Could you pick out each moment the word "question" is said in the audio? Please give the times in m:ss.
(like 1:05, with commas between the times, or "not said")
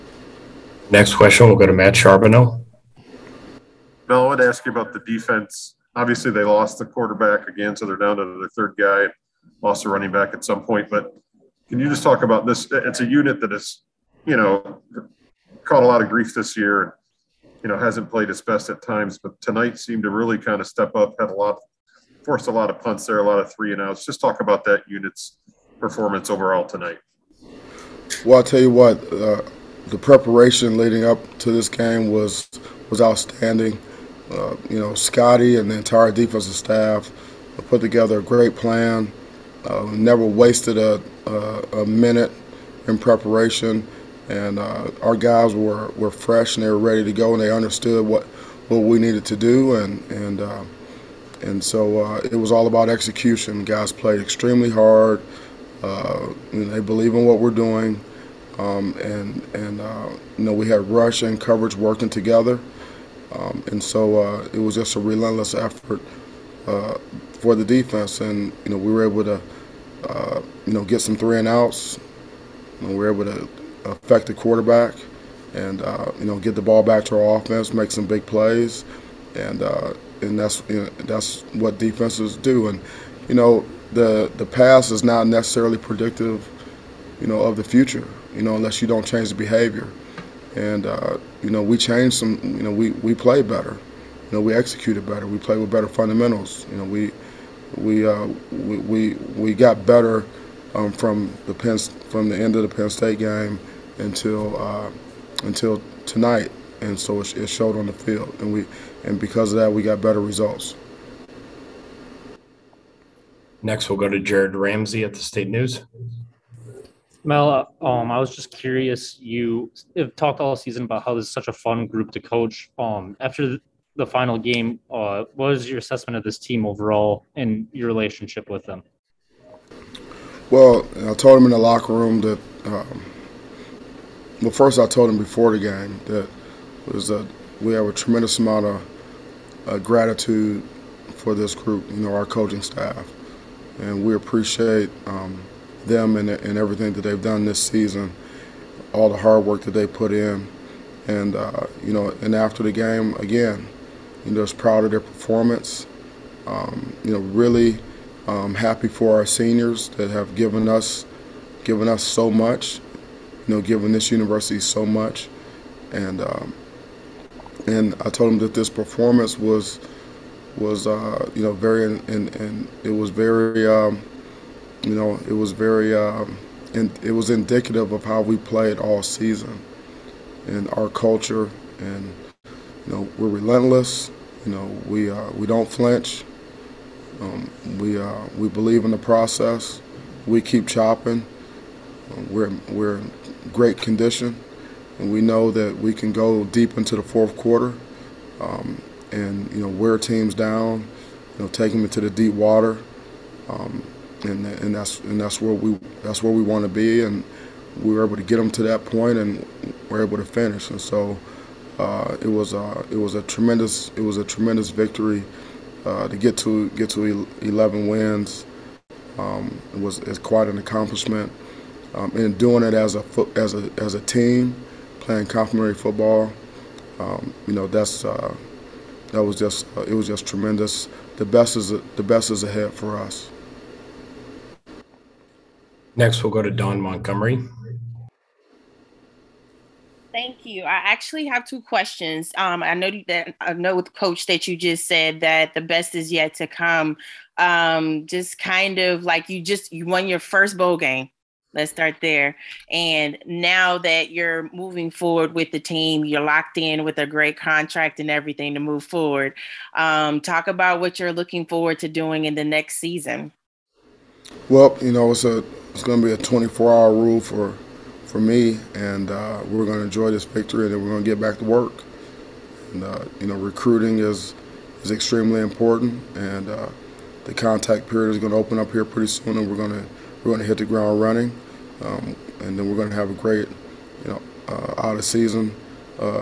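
0:01, 4:01.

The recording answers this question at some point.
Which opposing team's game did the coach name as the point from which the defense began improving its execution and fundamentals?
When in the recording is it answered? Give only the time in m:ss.
1:42.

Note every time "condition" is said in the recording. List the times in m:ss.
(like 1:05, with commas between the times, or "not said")
3:13.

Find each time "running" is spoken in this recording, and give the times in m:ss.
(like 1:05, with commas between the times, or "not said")
0:09, 4:41.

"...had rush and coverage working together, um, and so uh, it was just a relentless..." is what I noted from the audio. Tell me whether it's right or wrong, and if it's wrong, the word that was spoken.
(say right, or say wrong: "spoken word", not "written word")
right.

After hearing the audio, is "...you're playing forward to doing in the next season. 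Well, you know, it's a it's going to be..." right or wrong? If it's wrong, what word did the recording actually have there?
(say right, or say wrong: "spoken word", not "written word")
wrong: "looking", not "playing".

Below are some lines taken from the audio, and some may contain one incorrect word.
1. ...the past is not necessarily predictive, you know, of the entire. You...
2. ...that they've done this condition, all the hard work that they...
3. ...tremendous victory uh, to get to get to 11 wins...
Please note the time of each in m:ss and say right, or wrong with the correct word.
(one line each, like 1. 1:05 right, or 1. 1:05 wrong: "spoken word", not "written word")
1. 1:24 wrong: "future", not "entire"
2. 2:26 wrong: "season", not "condition"
3. 3:34 right.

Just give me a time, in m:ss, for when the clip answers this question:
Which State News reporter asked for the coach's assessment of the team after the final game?
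1:54.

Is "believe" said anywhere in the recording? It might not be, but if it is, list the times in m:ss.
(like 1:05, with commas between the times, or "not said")
0:56, 3:08.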